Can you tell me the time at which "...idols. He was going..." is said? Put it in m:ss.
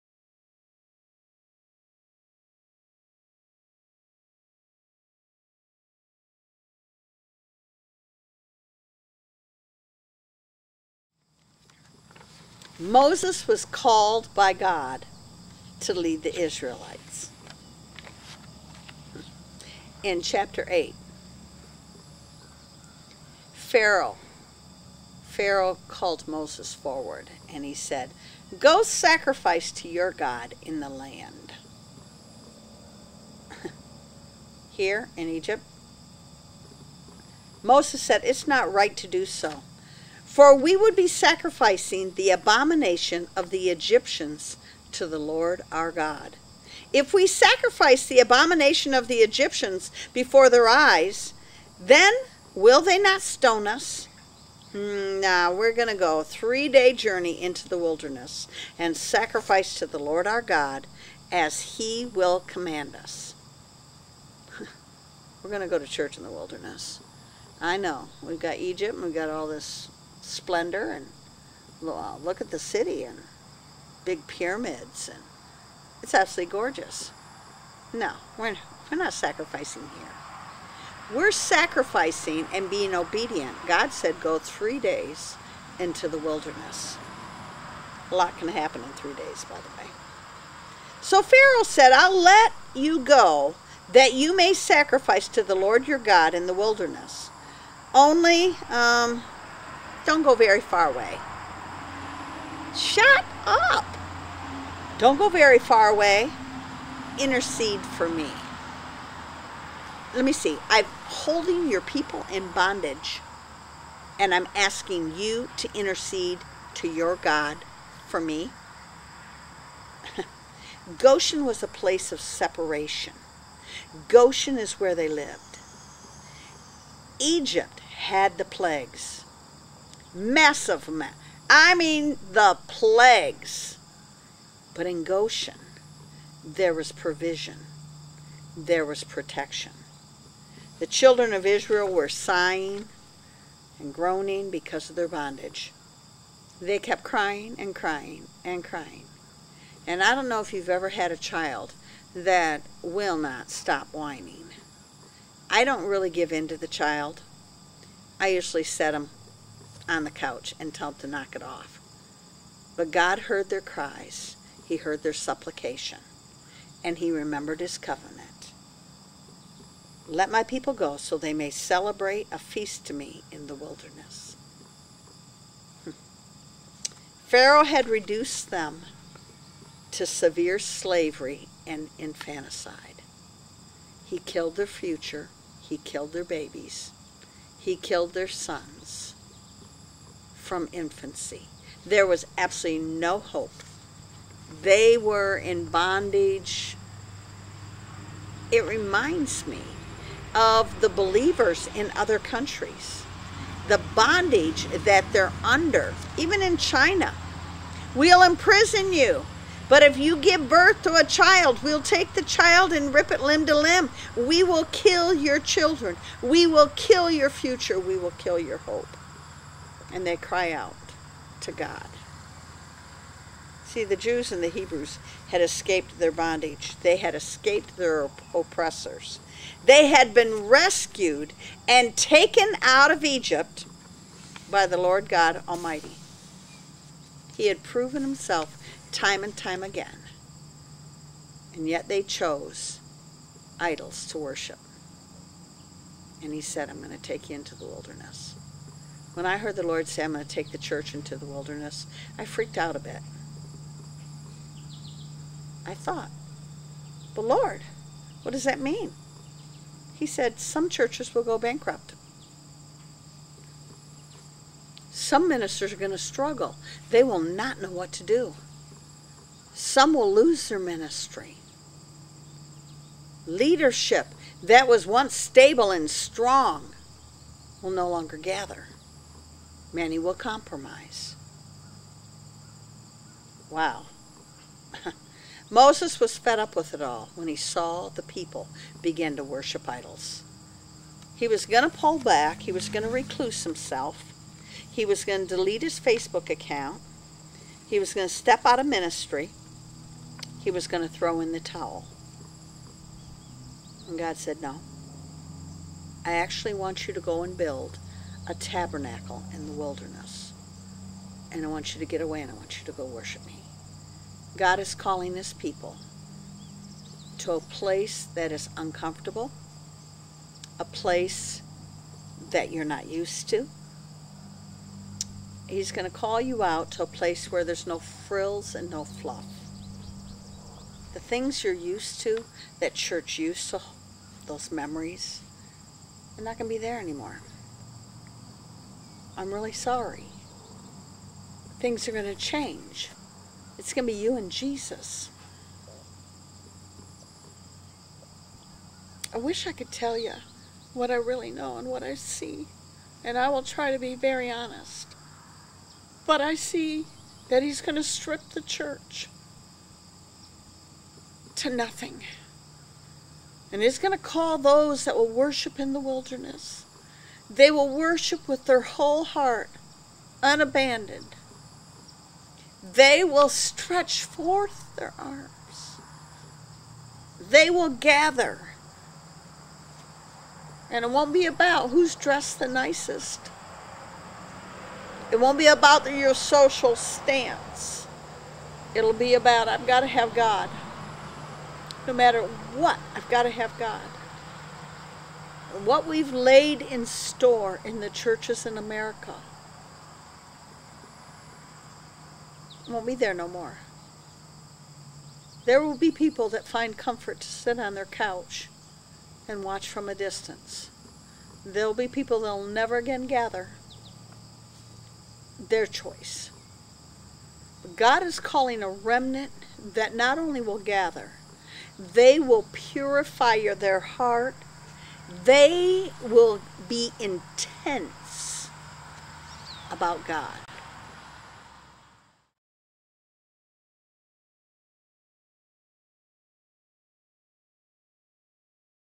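4:49.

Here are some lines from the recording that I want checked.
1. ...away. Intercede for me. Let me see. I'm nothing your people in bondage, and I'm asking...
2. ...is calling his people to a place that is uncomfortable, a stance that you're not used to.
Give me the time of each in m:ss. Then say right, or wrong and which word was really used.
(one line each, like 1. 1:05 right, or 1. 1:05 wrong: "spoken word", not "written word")
1. 1:45 wrong: "holding", not "nothing"
2. 5:14 wrong: "place", not "stance".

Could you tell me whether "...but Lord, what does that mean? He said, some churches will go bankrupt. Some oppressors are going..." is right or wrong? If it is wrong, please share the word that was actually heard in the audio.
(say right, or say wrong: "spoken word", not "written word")
wrong: "ministers", not "oppressors".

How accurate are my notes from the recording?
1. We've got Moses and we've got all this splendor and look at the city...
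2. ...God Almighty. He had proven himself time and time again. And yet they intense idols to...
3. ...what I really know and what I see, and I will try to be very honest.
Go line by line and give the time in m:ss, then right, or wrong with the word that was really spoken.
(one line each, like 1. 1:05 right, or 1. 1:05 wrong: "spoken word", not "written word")
1. 1:08 wrong: "Egypt", not "Moses"
2. 3:55 wrong: "chose", not "intense"
3. 5:50 right.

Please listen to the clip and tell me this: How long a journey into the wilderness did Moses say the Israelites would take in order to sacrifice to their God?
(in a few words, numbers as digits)
3 days.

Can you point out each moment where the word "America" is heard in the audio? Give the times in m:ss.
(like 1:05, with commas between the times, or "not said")
6:38.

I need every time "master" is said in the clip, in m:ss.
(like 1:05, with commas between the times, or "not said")
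not said.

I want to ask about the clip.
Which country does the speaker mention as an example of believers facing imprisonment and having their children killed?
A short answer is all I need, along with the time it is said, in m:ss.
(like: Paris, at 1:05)
China, at 3:26.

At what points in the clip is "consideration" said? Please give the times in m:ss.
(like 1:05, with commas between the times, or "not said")
not said.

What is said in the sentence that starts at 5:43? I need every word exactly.
It's going to be you and Jesus.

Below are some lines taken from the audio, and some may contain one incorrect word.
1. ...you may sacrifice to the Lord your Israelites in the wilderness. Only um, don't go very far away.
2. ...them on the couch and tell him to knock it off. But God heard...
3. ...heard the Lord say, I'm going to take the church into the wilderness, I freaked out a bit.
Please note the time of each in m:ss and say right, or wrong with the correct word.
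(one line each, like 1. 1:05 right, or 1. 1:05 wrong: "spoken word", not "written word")
1. 1:34 wrong: "God", not "Israelites"
2. 2:38 right
3. 4:09 right.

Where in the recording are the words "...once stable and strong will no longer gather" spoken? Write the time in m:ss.
4:34.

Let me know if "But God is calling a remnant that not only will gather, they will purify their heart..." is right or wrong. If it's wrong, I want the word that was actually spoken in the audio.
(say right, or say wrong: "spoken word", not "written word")
right.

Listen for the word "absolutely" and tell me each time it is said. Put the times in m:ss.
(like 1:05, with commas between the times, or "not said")
1:16, 3:12.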